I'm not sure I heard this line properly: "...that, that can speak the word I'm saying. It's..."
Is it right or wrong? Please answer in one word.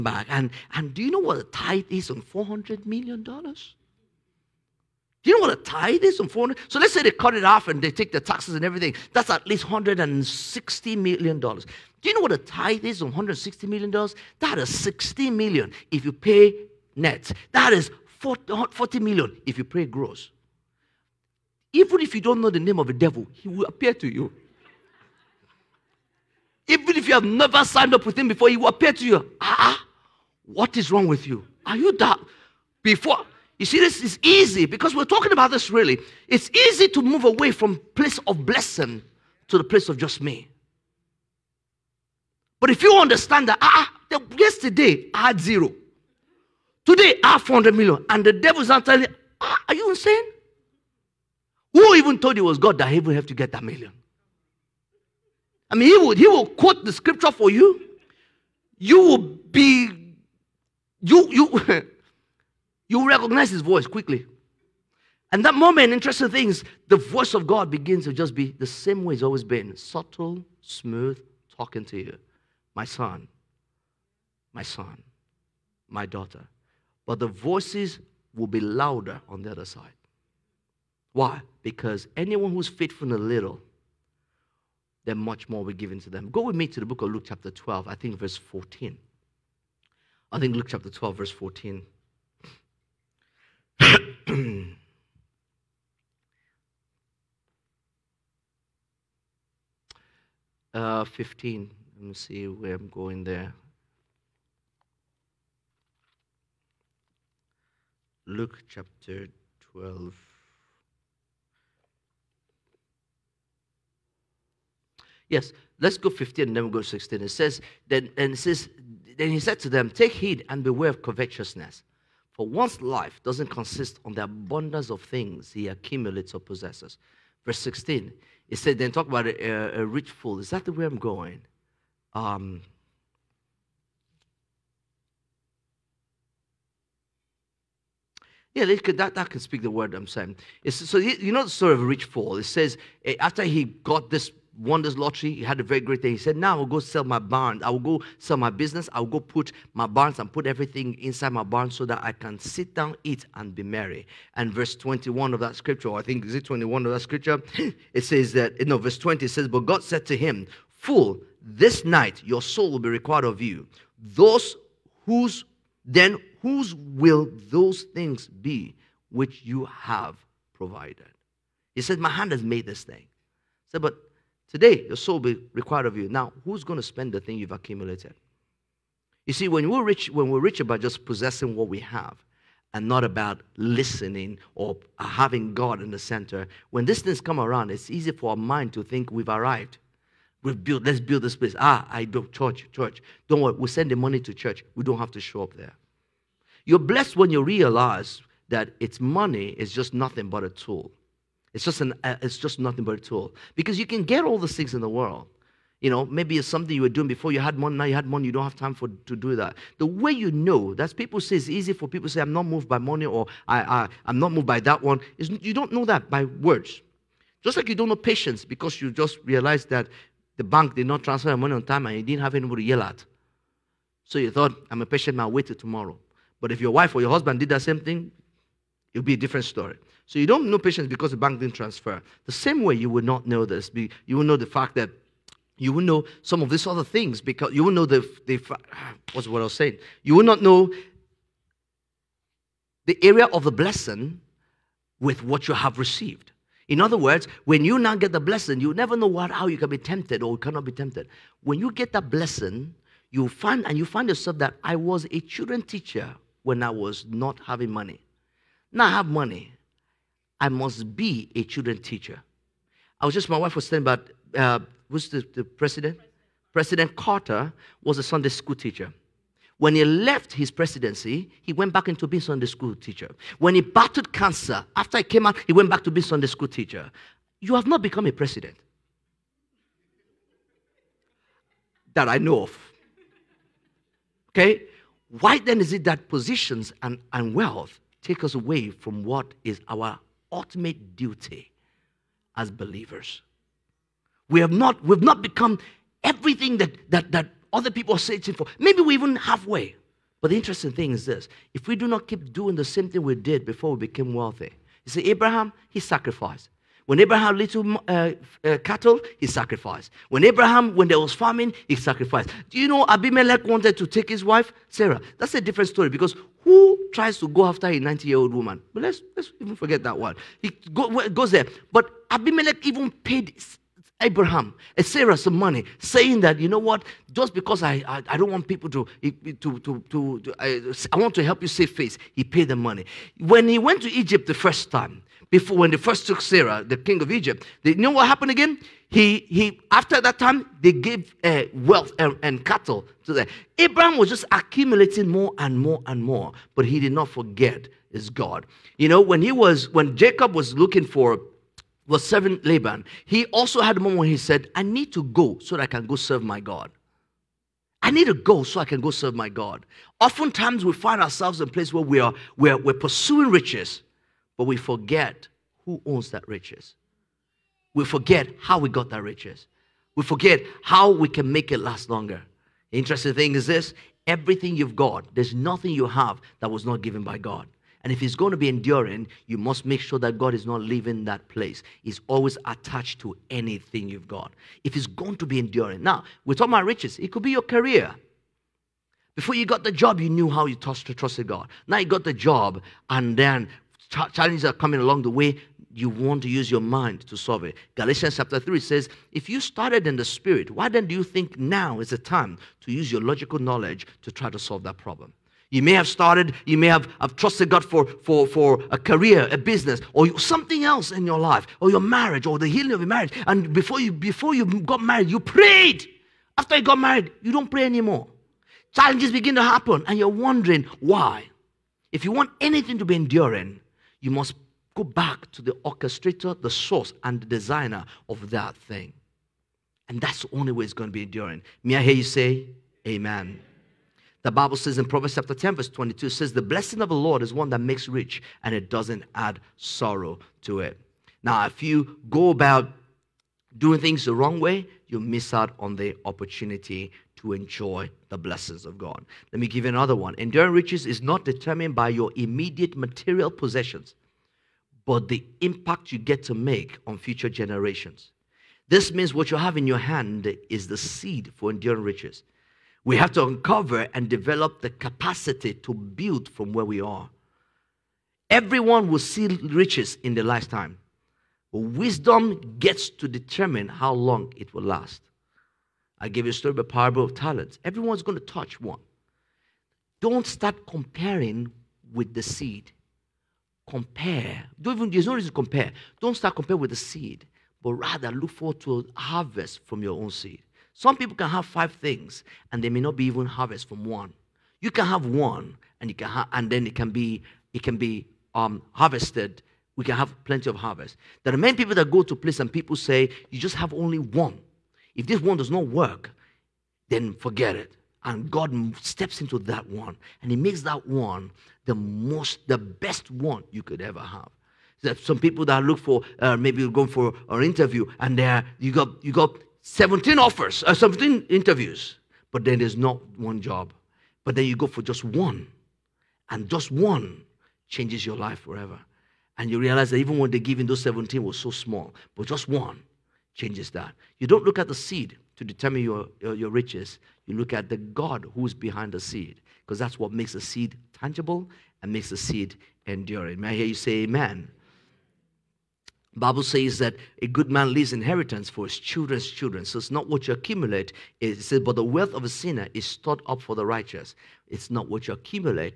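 right.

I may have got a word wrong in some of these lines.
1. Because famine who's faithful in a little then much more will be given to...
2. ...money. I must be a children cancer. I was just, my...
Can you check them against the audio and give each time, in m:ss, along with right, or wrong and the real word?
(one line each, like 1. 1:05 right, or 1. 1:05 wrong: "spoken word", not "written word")
1. 1:21 wrong: "anyone", not "famine"
2. 4:19 wrong: "teacher", not "cancer".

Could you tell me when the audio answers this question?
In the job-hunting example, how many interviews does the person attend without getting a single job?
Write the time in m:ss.
8:40.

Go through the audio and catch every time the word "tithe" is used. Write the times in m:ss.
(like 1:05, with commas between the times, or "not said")
0:01, 0:05, 0:12.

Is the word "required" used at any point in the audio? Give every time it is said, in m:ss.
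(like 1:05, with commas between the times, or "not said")
2:42, 2:55.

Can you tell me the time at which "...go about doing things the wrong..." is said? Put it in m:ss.
7:22.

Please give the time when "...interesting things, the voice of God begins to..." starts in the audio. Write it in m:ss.
1:05.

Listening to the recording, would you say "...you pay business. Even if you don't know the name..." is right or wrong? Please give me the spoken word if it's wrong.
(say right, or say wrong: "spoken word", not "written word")
wrong: "gross", not "business".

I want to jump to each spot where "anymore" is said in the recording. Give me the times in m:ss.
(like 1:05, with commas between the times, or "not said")
6:57.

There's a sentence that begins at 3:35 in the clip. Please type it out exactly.
It's, you don't know that by words.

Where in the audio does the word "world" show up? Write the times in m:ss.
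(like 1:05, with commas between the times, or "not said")
3:24.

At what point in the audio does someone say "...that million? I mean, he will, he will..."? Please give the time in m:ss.
0:53.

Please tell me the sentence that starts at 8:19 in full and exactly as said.
We can have plenty of harvest.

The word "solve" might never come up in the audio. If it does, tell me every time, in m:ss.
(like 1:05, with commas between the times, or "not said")
6:37, 6:44.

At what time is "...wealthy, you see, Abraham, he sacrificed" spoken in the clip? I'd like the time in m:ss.
5:04.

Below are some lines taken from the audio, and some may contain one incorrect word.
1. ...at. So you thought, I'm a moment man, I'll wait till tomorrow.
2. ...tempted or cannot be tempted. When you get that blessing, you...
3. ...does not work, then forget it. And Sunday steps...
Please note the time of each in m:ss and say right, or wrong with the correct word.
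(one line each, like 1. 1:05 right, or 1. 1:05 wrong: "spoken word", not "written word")
1. 3:42 wrong: "patient", not "moment"
2. 4:09 right
3. 8:25 wrong: "God", not "Sunday".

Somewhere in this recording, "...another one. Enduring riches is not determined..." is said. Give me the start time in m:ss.
7:29.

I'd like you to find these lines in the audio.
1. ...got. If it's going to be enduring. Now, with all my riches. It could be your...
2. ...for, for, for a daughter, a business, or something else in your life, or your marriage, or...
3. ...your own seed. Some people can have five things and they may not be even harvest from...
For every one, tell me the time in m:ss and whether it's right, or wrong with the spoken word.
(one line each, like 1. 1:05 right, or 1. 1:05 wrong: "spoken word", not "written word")
1. 6:24 right
2. 6:47 wrong: "career", not "daughter"
3. 8:09 right.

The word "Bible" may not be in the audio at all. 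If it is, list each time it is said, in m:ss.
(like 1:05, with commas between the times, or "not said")
7:14, 9:06.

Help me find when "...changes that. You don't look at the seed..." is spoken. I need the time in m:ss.
8:53.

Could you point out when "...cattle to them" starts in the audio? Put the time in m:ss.
5:42.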